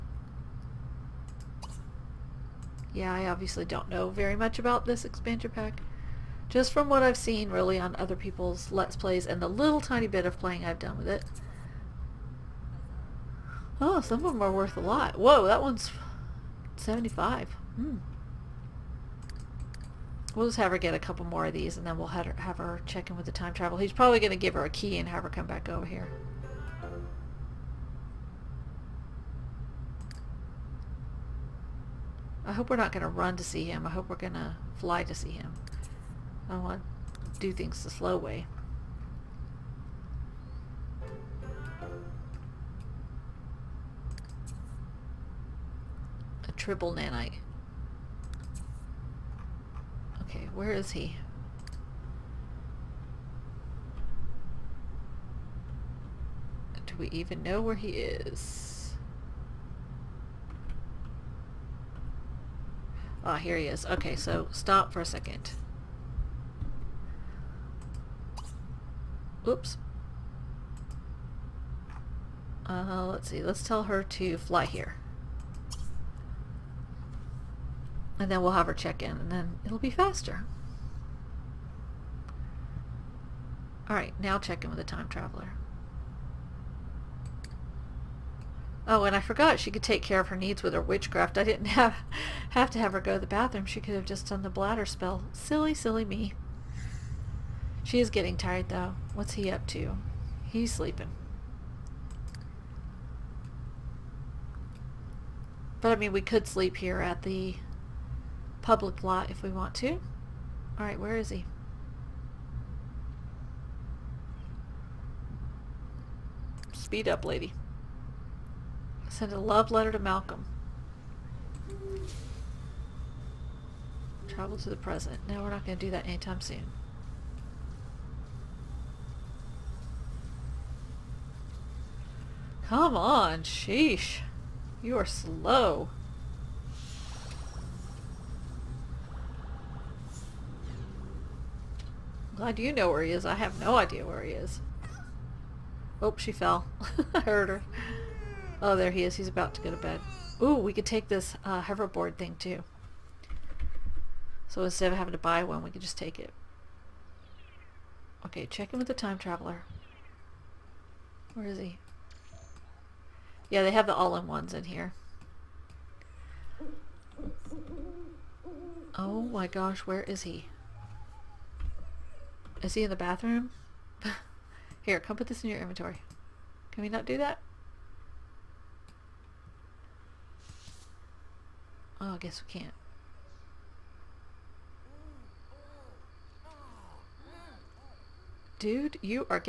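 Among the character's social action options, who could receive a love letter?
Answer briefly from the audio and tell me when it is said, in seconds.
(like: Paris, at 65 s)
Malcolm, at 119 s.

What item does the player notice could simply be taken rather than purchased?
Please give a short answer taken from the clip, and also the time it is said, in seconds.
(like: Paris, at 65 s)
hoverboard, at 151 s.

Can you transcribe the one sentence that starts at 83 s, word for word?
Alright, now check in with the time traveler.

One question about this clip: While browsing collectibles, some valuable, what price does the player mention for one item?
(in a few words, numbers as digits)
75.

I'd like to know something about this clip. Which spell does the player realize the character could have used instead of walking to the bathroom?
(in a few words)
bladder spell.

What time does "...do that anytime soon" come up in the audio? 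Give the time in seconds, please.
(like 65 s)
125 s.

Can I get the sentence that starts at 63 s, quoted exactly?
Okay, so stop for a second.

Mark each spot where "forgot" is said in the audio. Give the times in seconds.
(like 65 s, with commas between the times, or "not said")
89 s.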